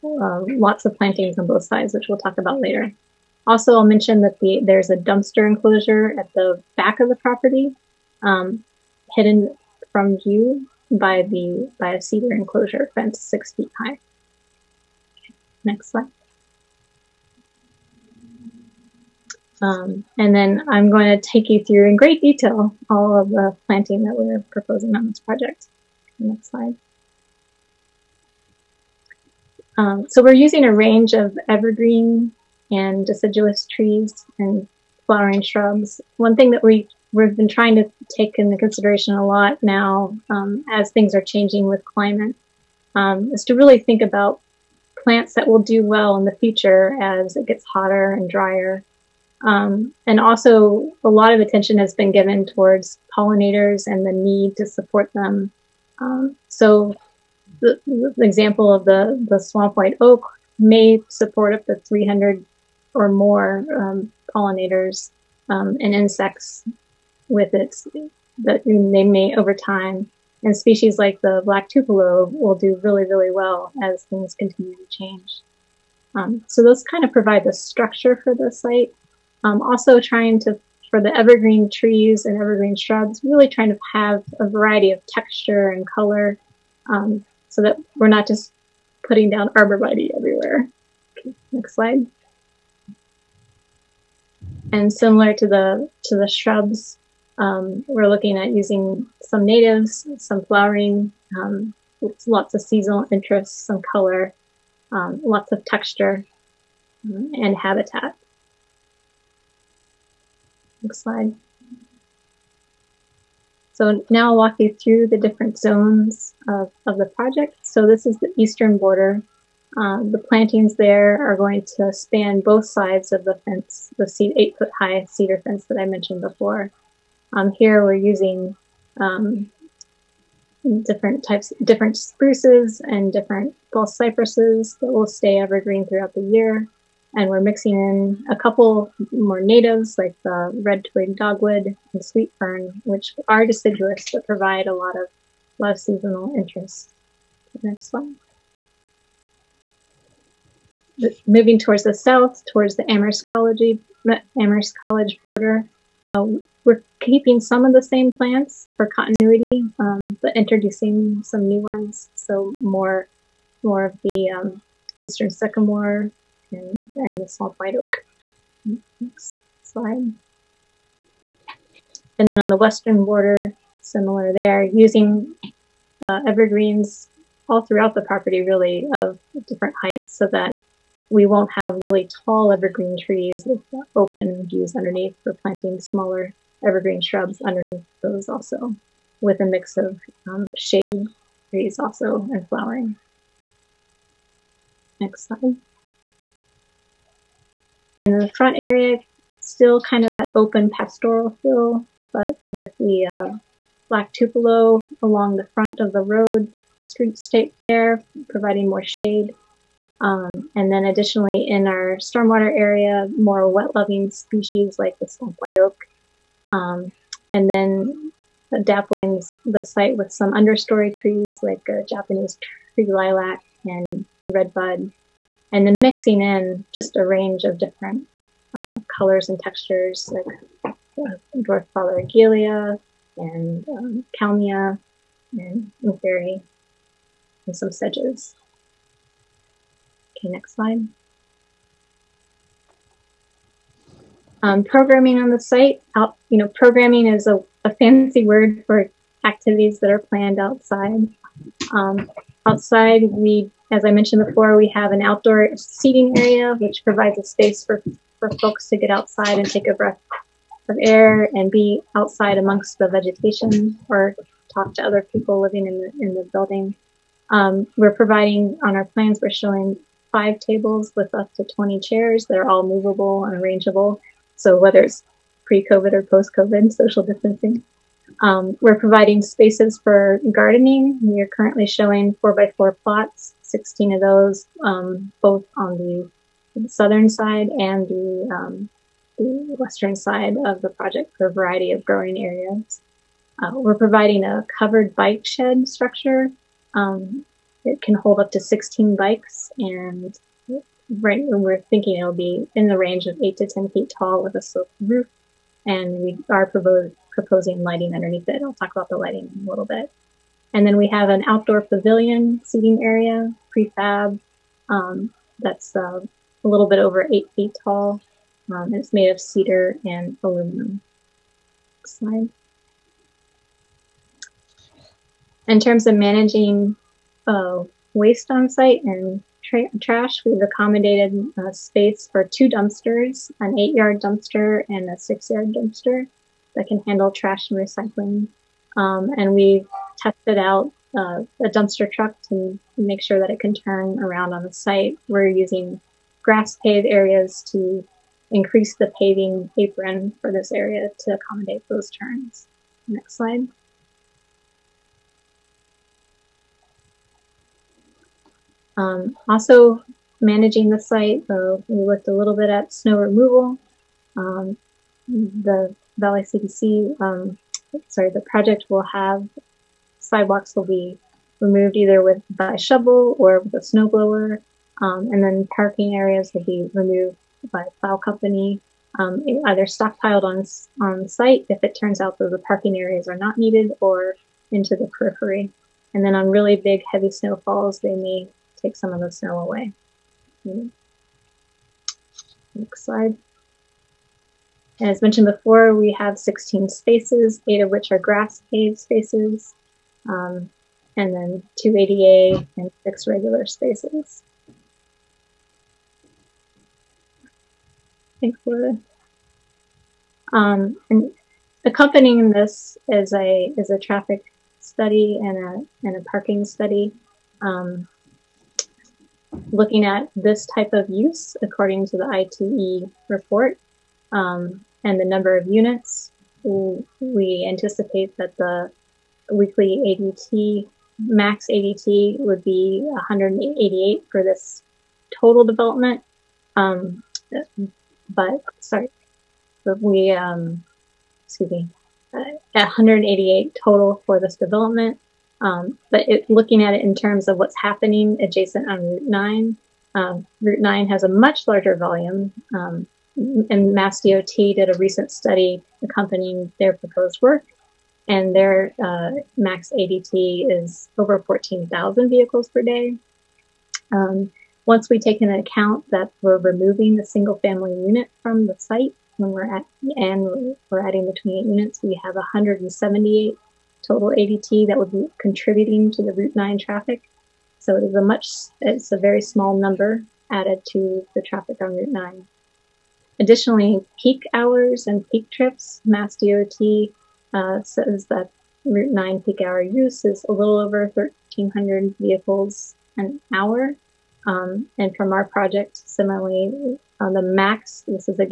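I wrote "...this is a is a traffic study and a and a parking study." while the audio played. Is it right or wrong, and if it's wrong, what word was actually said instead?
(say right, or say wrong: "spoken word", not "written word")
right.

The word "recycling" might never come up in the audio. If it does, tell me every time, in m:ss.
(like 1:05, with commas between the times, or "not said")
5:37.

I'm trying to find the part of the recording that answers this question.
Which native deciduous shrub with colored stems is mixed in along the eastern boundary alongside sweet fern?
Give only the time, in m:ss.
2:20.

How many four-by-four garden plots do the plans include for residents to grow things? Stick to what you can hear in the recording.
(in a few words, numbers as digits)
16.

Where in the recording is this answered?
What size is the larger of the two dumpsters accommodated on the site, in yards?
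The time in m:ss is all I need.
5:33.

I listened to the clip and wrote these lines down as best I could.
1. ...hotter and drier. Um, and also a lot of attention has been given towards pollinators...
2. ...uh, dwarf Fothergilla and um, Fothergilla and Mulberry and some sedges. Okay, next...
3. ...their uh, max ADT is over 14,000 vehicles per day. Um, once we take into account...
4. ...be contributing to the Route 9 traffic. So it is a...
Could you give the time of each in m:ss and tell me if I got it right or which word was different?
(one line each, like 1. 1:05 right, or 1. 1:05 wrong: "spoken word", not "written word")
1. 0:47 right
2. 3:50 wrong: "Kalmia", not "Fothergilla"
3. 7:38 right
4. 7:54 right.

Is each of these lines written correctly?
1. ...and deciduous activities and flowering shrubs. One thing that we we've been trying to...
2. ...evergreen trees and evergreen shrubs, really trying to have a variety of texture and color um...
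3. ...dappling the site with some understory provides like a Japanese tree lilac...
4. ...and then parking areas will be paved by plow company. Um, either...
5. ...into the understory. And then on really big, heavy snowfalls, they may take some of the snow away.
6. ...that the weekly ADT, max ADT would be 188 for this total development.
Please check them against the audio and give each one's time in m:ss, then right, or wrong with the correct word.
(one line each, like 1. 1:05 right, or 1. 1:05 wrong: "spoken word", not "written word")
1. 0:32 wrong: "trees", not "activities"
2. 1:21 right
3. 3:38 wrong: "trees", not "provides"
4. 6:15 wrong: "removed", not "paved"
5. 6:24 wrong: "periphery", not "understory"
6. 7:08 right.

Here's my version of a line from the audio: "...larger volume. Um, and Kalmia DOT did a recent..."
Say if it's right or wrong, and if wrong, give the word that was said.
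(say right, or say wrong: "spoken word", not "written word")
wrong: "Mass", not "Kalmia".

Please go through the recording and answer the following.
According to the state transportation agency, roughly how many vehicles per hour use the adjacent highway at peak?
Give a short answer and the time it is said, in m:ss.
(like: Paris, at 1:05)
1,300, at 8:10.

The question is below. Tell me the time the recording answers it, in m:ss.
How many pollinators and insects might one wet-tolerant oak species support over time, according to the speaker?
1:01.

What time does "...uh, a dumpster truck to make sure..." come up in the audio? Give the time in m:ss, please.
5:40.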